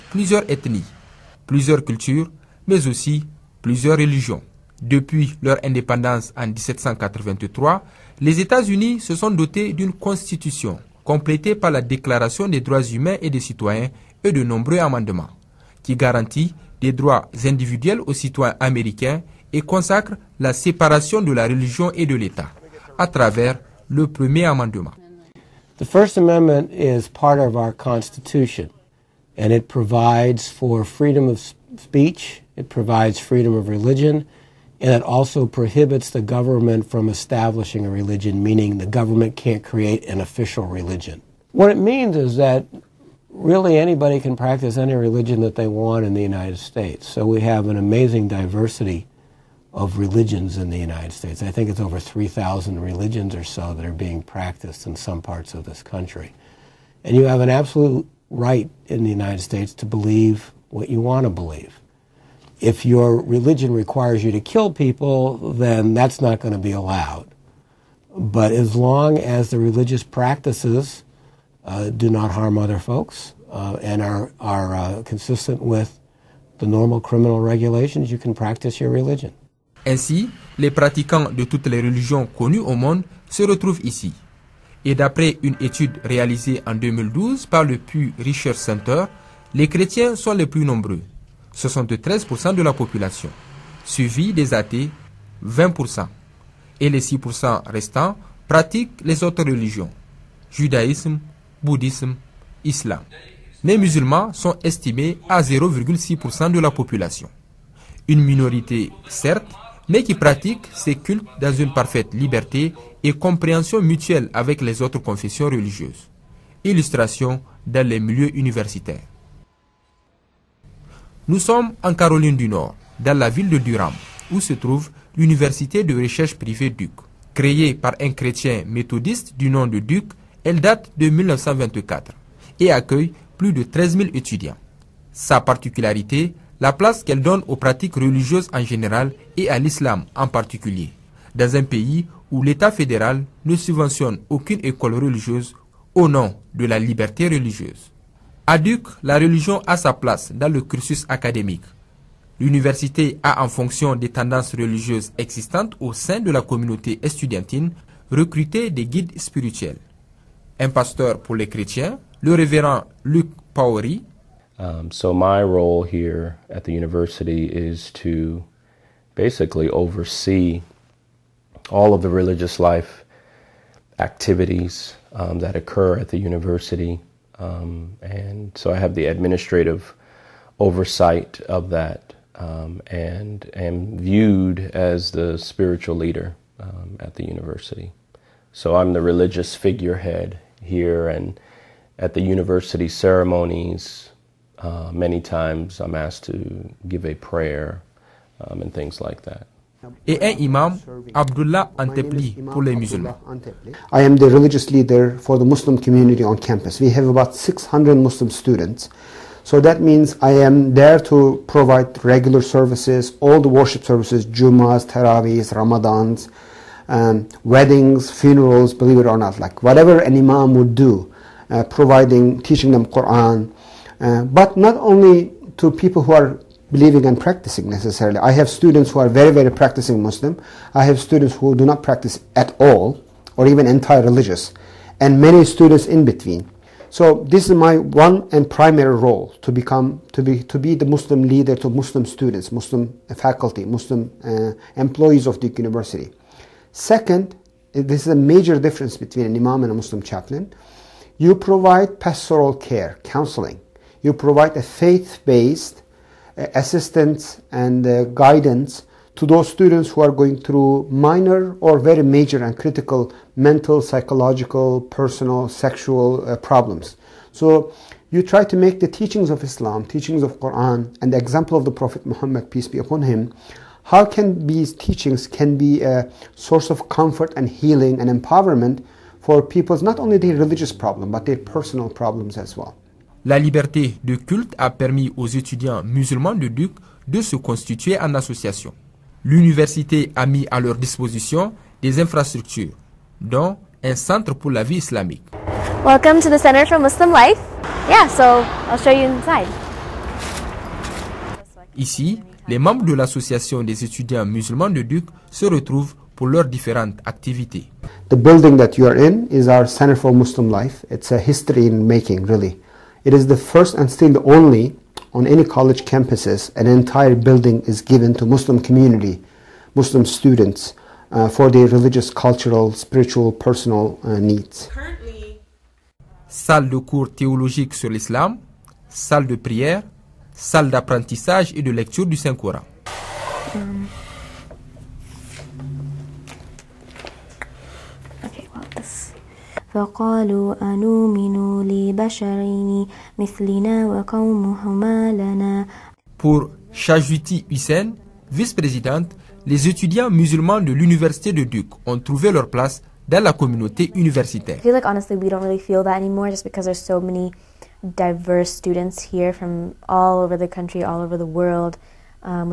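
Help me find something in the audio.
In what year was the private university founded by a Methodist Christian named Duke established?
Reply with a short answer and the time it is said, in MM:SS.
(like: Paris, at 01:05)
1924, at 02:11.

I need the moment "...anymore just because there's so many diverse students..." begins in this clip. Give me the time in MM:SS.
05:56.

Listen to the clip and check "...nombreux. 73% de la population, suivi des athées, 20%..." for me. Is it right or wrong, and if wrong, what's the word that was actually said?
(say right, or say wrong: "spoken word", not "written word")
right.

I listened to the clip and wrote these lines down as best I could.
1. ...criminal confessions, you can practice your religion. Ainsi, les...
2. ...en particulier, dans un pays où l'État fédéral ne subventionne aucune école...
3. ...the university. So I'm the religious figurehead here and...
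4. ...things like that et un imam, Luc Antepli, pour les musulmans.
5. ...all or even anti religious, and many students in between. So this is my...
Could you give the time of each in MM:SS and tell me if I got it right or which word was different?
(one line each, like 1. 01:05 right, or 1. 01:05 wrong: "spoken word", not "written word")
1. 01:17 wrong: "regulations", not "confessions"
2. 02:20 right
3. 03:07 right
4. 03:18 wrong: "Abdullah", not "Luc"
5. 03:52 right.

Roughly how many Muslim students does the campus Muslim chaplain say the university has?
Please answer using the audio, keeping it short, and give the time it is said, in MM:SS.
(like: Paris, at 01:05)
600, at 03:27.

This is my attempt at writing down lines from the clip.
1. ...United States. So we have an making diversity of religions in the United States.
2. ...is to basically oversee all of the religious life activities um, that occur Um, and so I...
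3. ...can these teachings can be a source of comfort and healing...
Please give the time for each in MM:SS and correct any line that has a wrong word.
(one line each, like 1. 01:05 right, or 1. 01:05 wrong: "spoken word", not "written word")
1. 00:46 wrong: "amazing", not "making"
2. 02:47 right
3. 04:34 right.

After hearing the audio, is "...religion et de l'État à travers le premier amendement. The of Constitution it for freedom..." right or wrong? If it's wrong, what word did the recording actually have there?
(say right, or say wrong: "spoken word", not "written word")
right.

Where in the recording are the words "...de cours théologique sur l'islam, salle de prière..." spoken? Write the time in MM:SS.
05:26.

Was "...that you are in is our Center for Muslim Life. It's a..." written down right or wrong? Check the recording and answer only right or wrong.
right.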